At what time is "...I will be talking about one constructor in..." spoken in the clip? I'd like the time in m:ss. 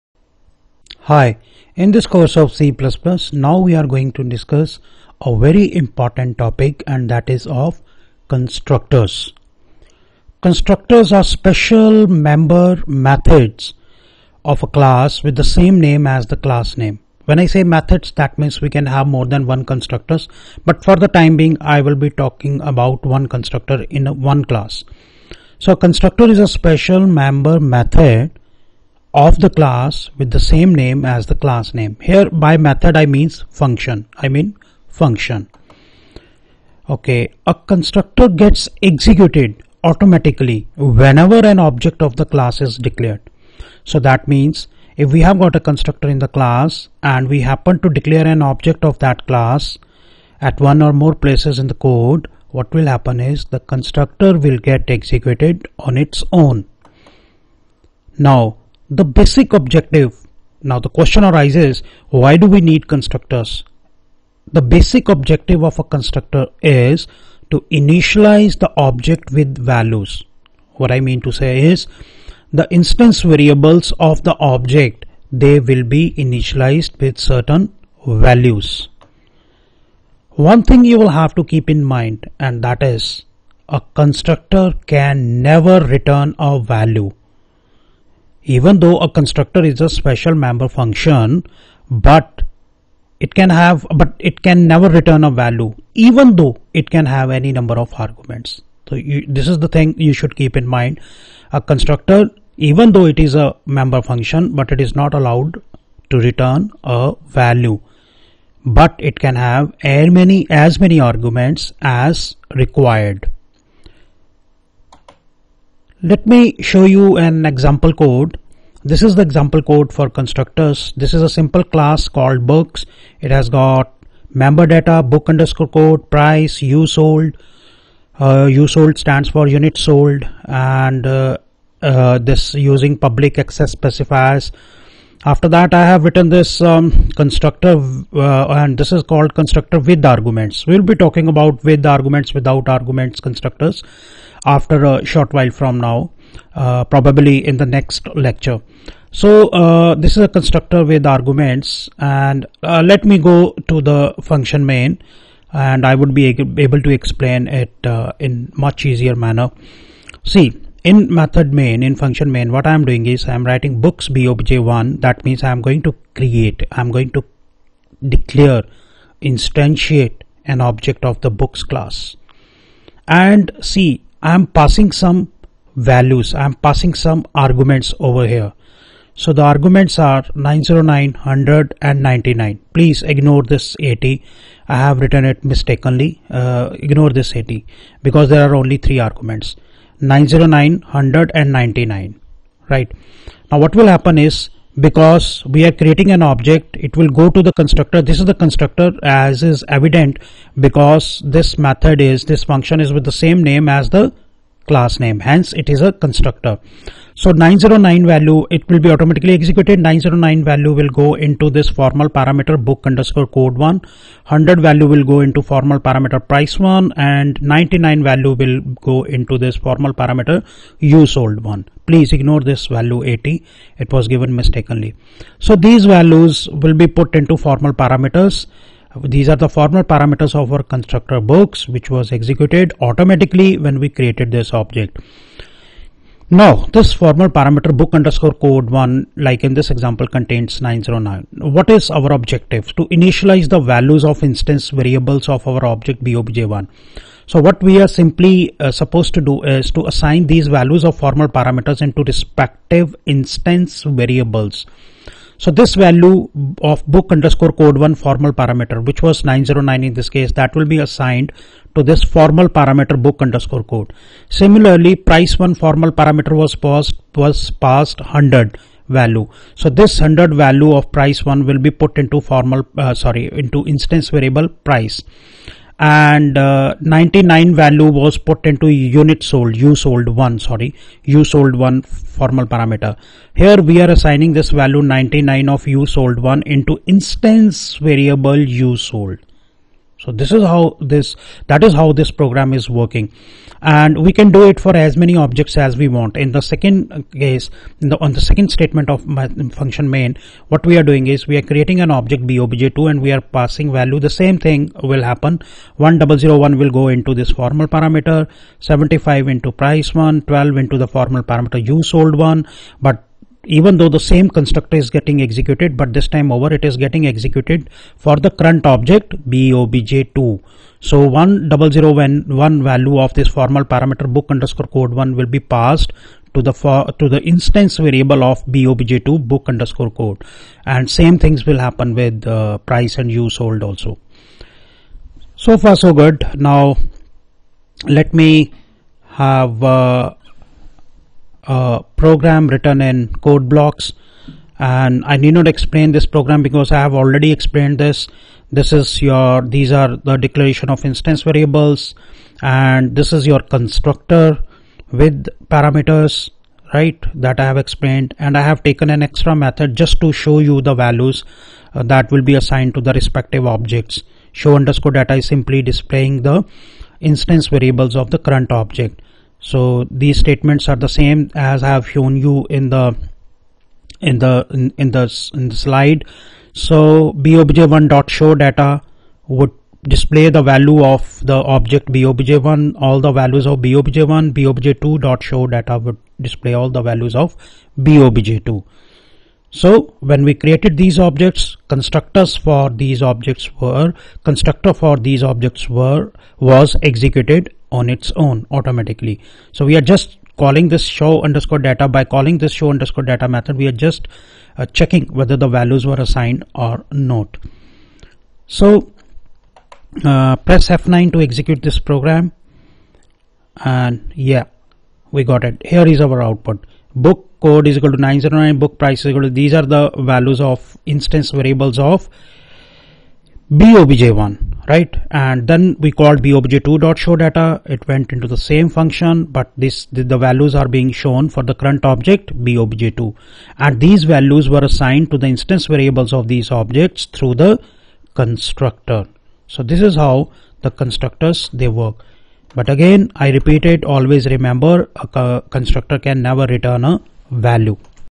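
0:21.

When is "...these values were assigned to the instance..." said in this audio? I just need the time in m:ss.
7:13.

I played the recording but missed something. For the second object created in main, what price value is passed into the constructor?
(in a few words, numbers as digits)
75.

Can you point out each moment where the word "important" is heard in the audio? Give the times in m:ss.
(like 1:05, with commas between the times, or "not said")
0:05.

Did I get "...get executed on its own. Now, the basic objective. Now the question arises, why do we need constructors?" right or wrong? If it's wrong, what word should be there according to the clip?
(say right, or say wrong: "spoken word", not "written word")
right.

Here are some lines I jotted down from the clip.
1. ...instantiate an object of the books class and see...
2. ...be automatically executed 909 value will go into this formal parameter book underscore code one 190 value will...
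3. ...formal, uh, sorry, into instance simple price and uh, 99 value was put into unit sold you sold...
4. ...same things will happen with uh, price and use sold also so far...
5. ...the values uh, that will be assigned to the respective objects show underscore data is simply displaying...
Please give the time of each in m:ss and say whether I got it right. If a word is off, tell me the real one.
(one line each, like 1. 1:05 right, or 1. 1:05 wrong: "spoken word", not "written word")
1. 2:49 right
2. 3:28 wrong: "100", not "190"
3. 4:32 wrong: "variable", not "simple"
4. 5:30 right
5. 6:00 right.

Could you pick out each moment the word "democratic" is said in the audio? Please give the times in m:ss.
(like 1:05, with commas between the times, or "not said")
not said.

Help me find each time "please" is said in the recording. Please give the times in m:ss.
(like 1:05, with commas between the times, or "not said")
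3:02, 3:41.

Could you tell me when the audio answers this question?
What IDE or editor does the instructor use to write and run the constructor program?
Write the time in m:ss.
5:43.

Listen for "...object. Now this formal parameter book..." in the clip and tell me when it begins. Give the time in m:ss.
3:54.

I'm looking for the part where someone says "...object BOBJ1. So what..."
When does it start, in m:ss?
4:05.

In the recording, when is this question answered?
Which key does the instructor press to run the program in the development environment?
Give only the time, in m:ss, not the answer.
6:50.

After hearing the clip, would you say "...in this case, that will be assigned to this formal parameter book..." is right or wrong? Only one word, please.
right.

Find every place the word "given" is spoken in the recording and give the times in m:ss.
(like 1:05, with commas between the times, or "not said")
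3:44.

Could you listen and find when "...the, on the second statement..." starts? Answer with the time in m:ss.
4:57.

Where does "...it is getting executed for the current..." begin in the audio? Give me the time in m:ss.
5:16.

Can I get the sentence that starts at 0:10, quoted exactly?
Constructors are special member methods of a class with the same name as the class name.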